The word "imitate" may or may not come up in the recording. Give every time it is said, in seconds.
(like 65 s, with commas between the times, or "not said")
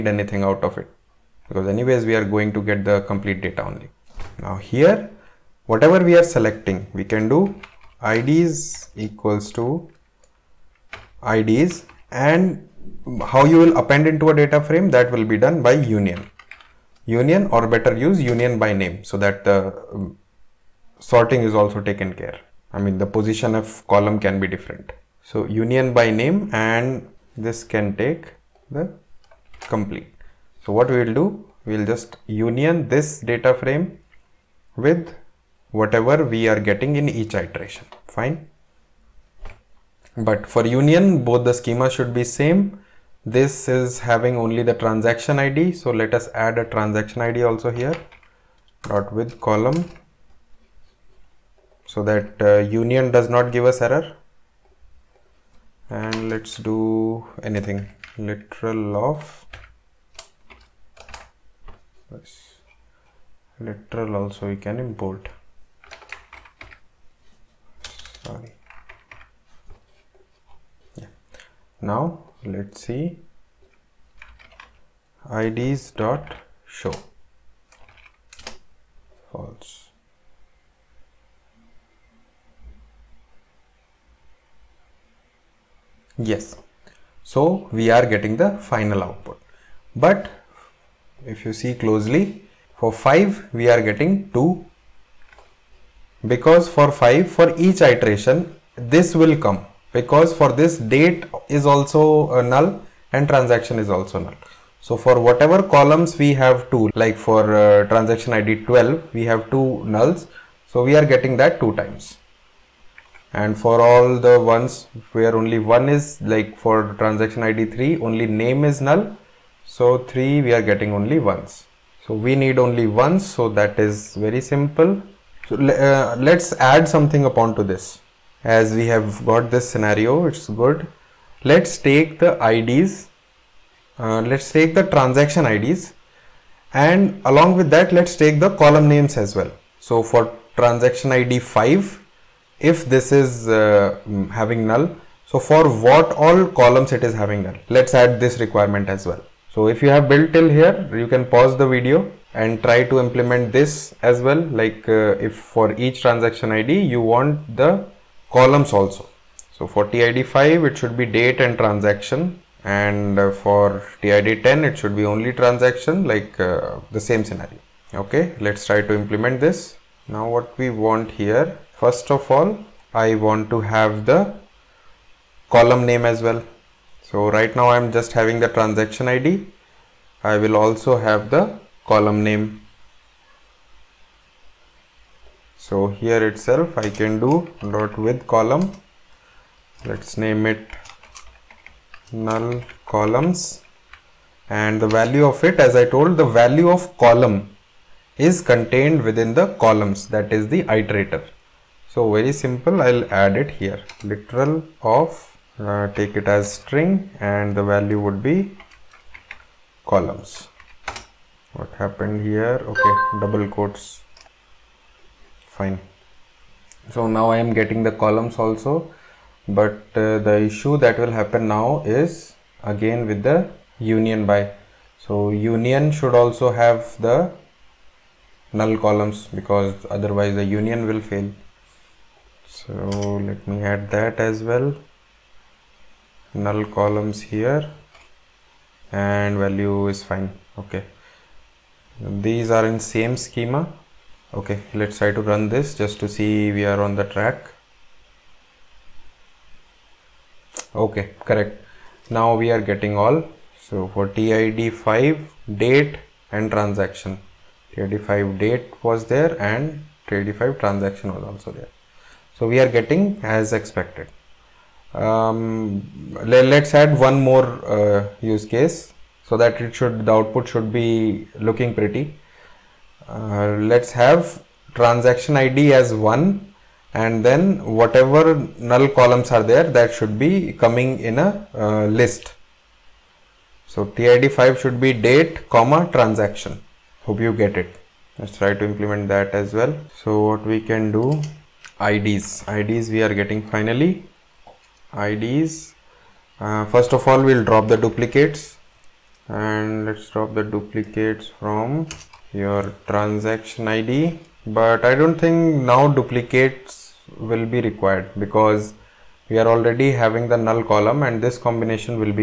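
not said.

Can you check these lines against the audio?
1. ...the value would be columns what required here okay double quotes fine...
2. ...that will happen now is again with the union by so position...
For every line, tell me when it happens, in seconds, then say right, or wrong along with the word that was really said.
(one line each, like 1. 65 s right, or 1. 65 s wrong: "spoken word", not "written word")
1. 207 s wrong: "happened", not "required"
2. 220 s wrong: "union", not "position".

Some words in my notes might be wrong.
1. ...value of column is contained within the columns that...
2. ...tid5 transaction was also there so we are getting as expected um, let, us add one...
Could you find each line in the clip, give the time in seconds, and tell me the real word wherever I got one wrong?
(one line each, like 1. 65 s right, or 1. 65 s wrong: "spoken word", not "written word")
1. 196 s right
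2. 260 s right.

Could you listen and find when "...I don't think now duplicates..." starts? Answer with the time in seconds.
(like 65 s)
304 s.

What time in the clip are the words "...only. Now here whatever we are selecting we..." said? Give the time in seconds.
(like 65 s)
3 s.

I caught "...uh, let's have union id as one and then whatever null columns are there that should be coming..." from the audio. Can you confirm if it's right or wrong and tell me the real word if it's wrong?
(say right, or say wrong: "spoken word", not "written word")
wrong: "transaction", not "union".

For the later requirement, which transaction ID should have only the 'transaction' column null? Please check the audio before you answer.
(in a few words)
10.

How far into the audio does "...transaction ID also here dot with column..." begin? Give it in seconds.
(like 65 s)
46 s.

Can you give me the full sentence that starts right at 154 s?
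Like uh, if for each transaction ID, you want the columns also.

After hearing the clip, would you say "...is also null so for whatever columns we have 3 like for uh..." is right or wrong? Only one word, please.
wrong.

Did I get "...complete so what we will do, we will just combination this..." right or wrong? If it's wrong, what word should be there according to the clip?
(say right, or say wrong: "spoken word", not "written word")
wrong: "union", not "combination".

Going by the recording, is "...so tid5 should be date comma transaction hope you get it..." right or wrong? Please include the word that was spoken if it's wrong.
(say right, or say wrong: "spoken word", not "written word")
right.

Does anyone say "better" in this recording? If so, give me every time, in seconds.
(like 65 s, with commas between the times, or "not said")
17 s.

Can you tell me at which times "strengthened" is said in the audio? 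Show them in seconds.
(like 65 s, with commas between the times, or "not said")
not said.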